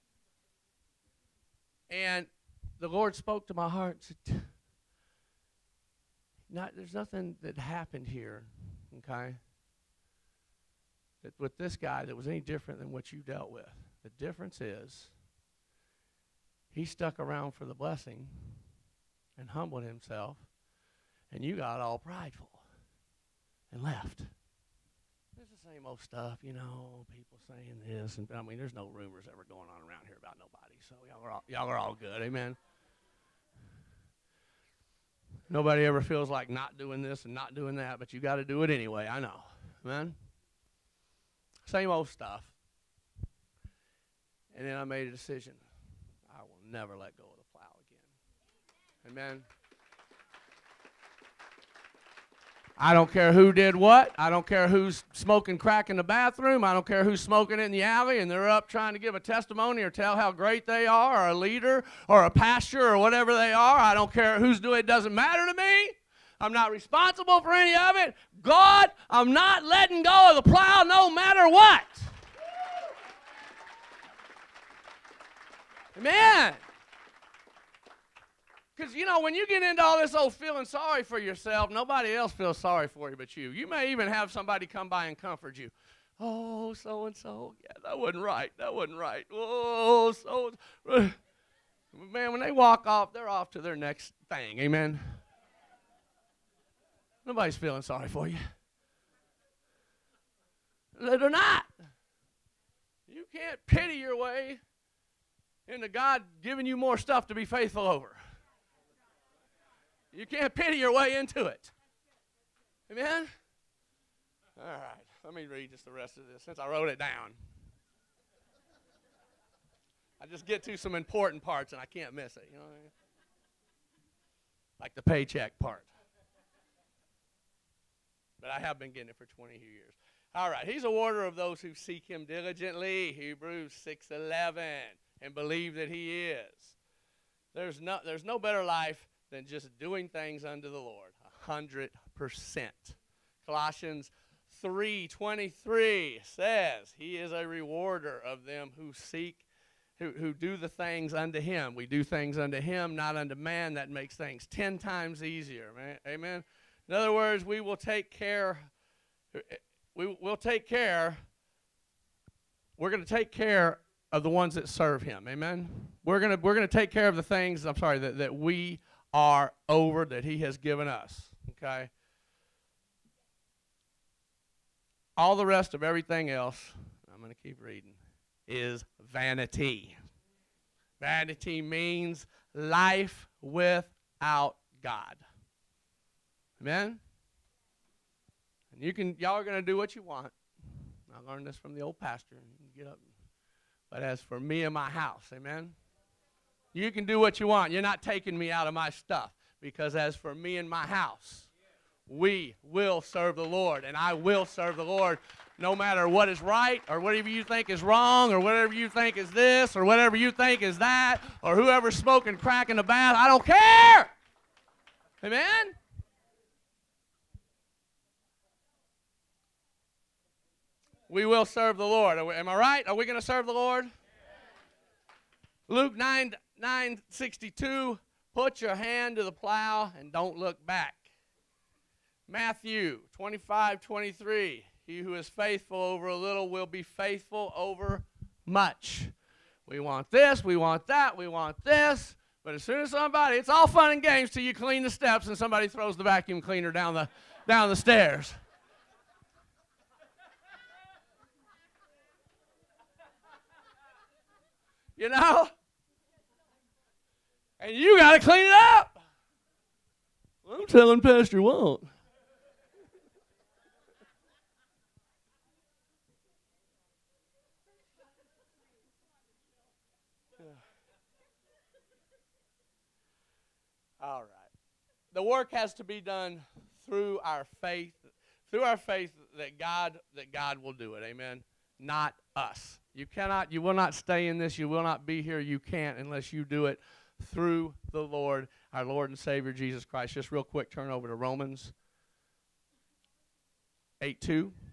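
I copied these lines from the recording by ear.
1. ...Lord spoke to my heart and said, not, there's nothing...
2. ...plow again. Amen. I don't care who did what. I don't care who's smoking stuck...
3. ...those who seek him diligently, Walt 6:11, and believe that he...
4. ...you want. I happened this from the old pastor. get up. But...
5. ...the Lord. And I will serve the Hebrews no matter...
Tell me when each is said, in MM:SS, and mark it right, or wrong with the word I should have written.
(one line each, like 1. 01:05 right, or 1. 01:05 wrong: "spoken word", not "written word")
1. 00:02 right
2. 00:47 wrong: "crack", not "stuck"
3. 02:11 wrong: "Hebrews", not "Walt"
4. 03:09 wrong: "learned", not "happened"
5. 03:23 wrong: "Lord", not "Hebrews".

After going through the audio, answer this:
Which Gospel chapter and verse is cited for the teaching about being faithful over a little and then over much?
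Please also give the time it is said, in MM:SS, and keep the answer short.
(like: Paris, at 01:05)
Matthew 25:23, at 03:52.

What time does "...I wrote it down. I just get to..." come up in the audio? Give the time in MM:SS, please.
01:56.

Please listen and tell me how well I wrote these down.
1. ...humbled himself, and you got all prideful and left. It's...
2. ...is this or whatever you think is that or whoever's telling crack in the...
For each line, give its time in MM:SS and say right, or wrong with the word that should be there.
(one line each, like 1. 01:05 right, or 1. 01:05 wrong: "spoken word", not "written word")
1. 00:19 right
2. 03:29 wrong: "smoking", not "telling".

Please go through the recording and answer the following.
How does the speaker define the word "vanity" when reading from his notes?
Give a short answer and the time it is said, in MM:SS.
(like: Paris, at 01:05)
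life without God, at 03:02.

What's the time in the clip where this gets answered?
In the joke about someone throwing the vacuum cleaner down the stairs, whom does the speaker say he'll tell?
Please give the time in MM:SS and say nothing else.
04:20.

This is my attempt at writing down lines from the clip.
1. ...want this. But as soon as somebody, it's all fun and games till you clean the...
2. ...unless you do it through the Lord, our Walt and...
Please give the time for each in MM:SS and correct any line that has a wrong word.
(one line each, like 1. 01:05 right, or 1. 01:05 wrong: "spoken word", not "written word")
1. 04:01 right
2. 04:45 wrong: "Lord", not "Walt".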